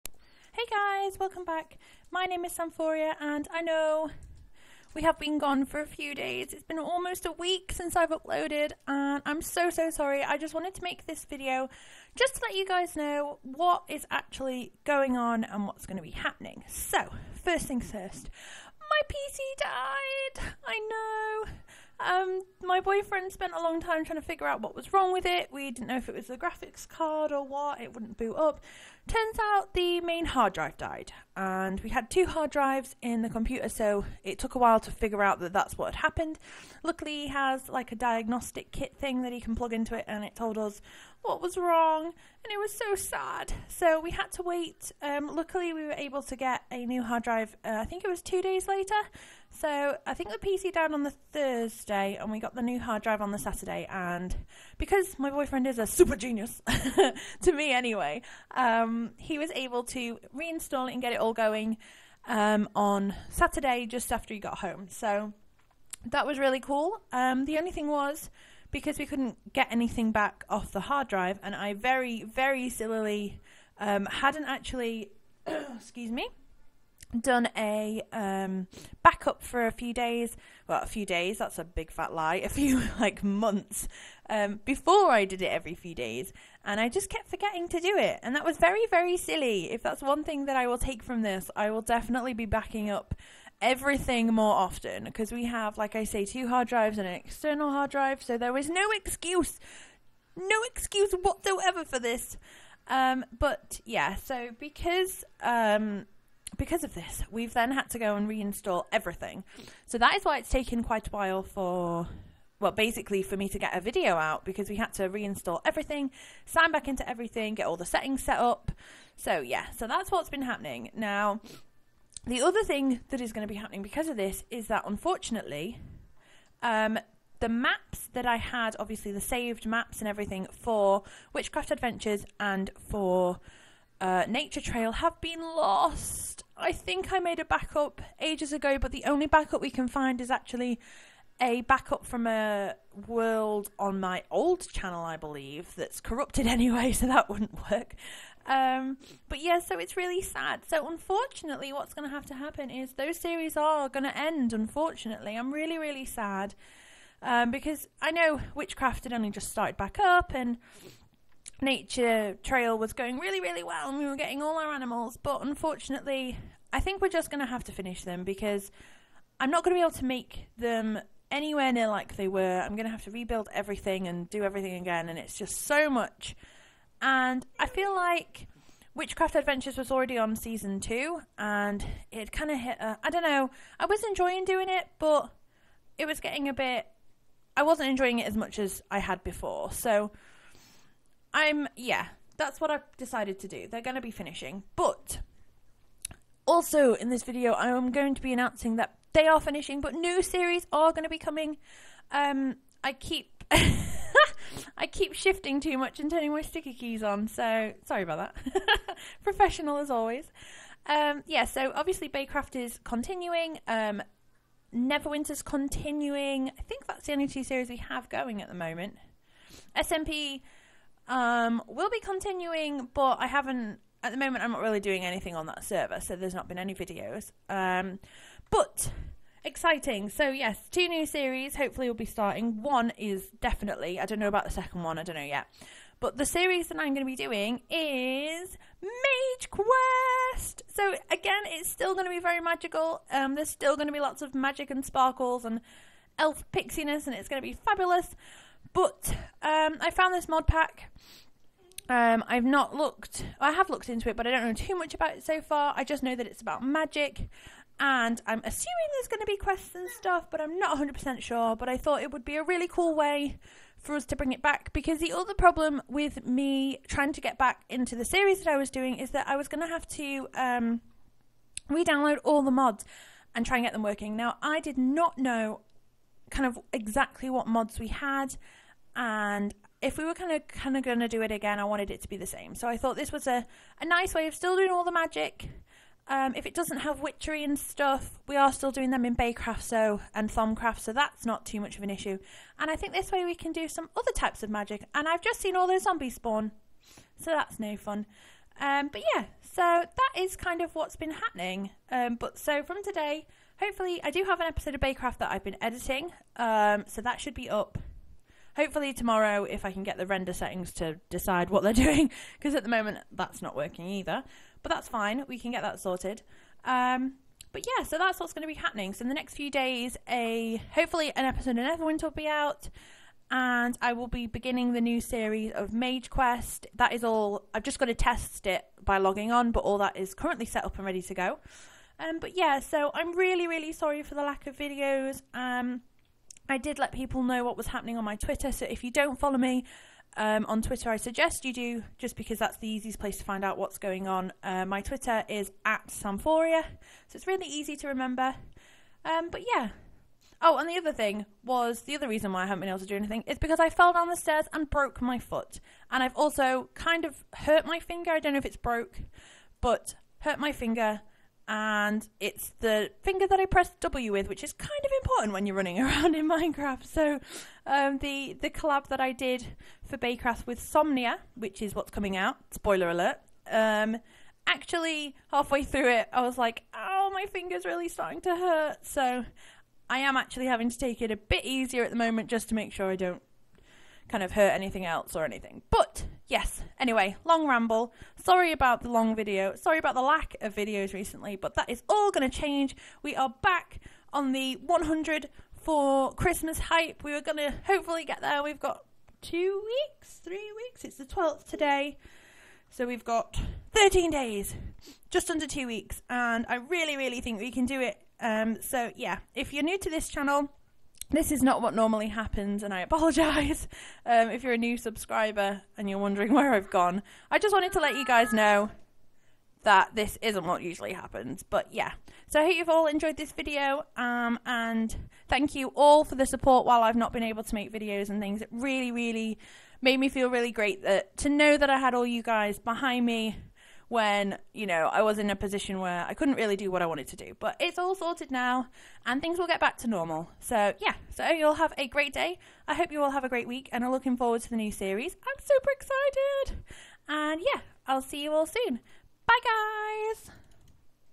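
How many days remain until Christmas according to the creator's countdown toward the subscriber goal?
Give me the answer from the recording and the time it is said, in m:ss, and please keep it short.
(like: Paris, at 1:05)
13, at 6:43.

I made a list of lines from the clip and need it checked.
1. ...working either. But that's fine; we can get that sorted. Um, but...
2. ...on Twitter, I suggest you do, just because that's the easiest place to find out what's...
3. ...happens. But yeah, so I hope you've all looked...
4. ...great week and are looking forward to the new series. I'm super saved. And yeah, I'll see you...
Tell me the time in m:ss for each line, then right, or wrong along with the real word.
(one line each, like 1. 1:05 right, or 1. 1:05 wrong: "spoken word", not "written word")
1. 5:13 right
2. 5:40 right
3. 7:00 wrong: "enjoyed", not "looked"
4. 7:23 wrong: "excited", not "saved".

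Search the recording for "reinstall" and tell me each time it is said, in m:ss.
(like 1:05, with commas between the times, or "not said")
1:00, 1:48, 1:55.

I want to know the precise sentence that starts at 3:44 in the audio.
I'm not really doing anything on that server, so there's not been any videos.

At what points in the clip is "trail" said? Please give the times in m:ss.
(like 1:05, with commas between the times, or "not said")
2:14, 2:42.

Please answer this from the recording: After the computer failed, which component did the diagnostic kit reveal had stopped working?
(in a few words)
Main hard drive.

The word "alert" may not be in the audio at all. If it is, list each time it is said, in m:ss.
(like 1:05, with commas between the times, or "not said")
6:12.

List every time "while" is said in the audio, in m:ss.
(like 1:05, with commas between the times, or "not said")
0:34, 1:51, 7:06.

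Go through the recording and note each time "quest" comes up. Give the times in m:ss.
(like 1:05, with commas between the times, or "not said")
3:59, 4:19, 5:26.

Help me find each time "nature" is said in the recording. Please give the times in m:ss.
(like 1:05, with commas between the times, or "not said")
2:14, 2:41.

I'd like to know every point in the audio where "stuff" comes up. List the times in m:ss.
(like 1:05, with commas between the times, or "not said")
4:19, 4:47.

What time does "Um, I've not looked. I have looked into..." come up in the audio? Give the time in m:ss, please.
4:11.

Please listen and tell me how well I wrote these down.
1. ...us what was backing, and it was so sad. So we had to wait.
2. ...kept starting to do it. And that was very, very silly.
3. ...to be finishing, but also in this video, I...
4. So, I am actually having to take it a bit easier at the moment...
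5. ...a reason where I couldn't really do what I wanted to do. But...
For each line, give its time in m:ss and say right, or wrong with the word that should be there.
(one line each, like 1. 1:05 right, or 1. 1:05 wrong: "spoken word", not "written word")
1. 0:40 wrong: "wrong", not "backing"
2. 1:27 wrong: "forgetting", not "starting"
3. 3:13 right
4. 6:18 right
5. 7:15 wrong: "position", not "reason".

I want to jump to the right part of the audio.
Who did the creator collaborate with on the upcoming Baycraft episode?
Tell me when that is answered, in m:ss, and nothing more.
6:10.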